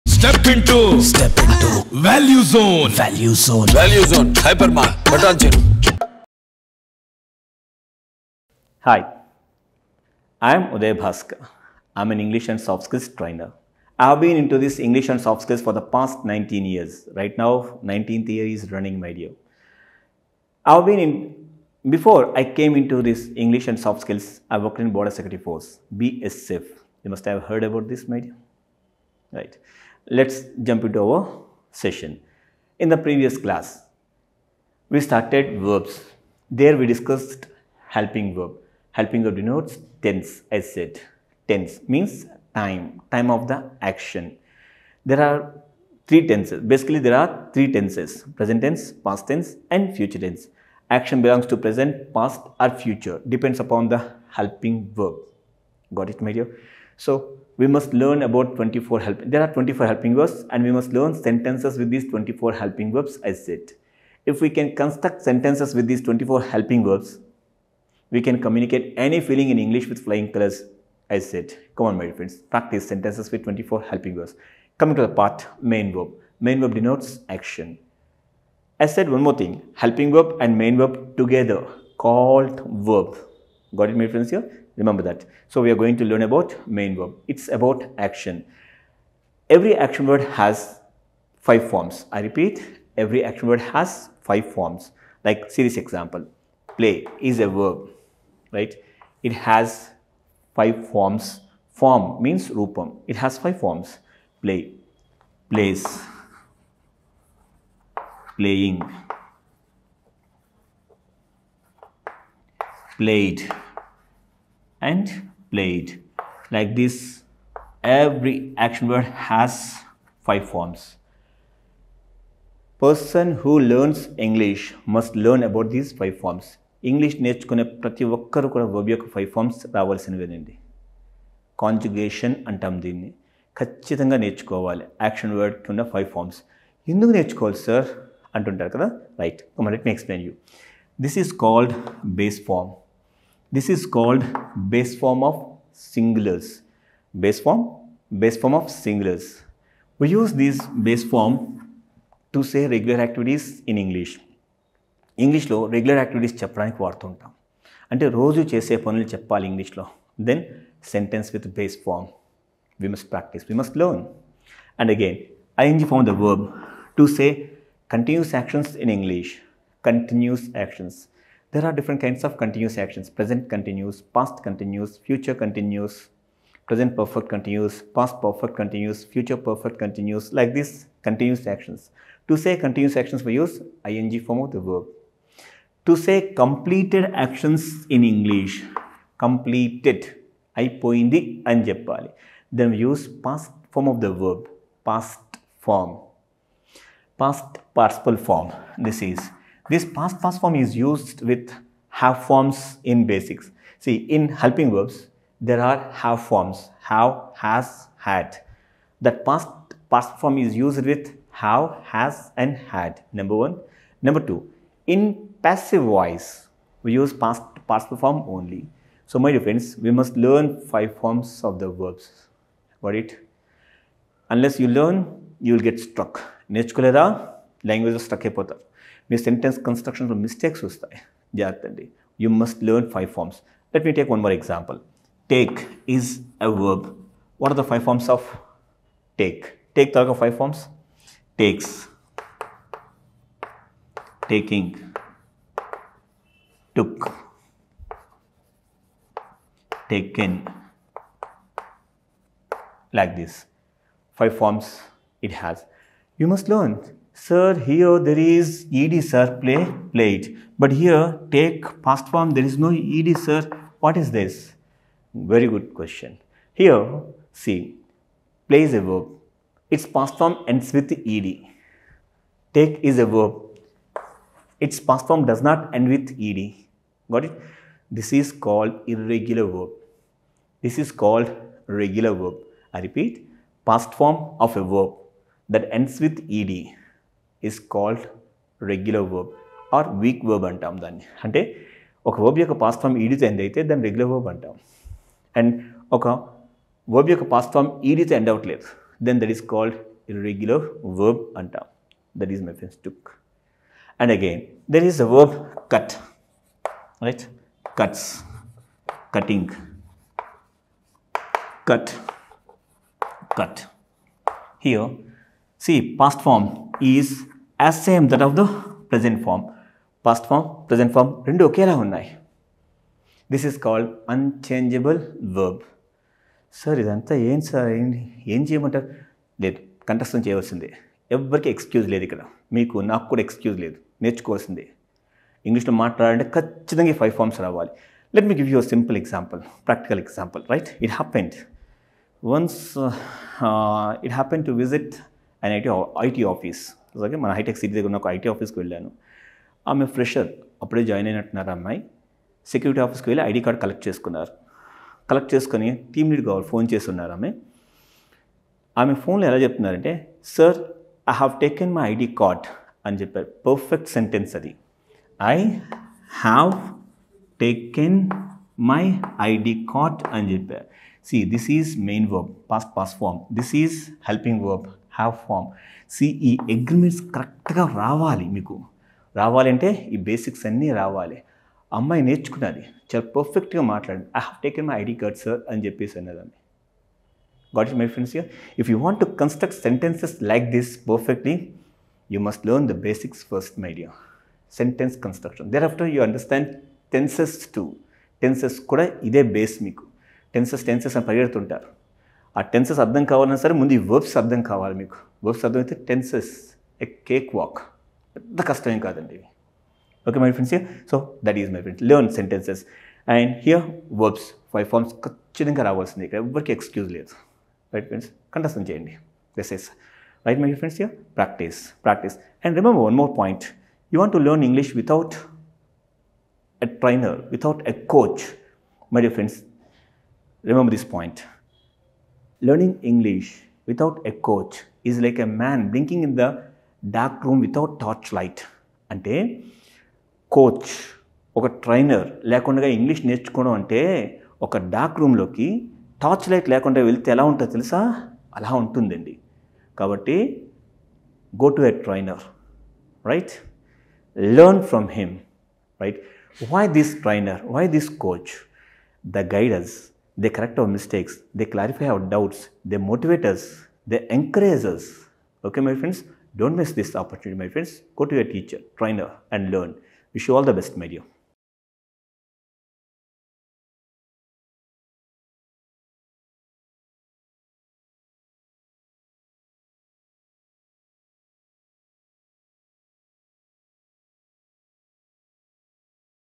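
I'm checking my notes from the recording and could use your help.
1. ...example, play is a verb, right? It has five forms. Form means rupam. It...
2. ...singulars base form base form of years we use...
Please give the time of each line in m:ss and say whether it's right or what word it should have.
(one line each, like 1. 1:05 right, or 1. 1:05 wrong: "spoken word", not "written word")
1. 1:35 right
2. 2:25 wrong: "singulars", not "years".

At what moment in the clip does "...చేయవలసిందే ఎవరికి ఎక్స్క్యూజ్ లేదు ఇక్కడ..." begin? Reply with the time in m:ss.
5:30.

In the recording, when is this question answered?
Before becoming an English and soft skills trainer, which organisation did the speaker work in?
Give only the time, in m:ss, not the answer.
0:24.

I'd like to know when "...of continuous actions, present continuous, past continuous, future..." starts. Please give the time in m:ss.
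2:52.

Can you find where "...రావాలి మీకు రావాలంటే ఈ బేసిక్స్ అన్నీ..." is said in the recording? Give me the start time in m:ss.
6:17.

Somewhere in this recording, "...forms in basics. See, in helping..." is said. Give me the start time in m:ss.
3:22.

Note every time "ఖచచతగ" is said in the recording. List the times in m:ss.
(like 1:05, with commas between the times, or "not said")
2:13, 5:36, 6:55.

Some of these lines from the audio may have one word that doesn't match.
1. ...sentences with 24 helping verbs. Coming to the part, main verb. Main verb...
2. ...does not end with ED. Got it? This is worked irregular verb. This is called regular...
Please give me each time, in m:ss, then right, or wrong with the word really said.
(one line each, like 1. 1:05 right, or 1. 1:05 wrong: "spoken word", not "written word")
1. 1:12 right
2. 4:35 wrong: "called", not "worked".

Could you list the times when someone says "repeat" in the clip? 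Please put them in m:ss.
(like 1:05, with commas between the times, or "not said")
1:32, 4:42.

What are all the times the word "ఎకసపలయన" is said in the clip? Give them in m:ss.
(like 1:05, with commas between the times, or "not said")
2:19.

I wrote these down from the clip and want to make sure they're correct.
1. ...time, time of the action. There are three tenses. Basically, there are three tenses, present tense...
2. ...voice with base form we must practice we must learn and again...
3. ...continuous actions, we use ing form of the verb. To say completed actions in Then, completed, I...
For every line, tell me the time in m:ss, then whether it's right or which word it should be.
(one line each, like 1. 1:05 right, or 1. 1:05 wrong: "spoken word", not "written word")
1. 0:42 right
2. 2:40 wrong: "sentence", not "voice"
3. 3:02 wrong: "English", not "Then".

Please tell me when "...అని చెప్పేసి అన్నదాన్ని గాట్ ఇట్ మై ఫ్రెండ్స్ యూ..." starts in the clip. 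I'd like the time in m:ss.
6:25.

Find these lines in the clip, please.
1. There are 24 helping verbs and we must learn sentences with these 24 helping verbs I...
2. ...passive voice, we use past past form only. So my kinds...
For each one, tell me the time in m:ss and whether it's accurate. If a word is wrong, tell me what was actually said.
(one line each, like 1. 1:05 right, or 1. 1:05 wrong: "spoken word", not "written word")
1. 0:59 right
2. 3:35 wrong: "friends", not "kinds".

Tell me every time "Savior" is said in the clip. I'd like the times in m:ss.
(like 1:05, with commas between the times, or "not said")
not said.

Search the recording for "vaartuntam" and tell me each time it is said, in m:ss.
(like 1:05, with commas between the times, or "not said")
2:36.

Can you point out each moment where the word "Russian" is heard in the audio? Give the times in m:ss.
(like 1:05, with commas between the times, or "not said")
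not said.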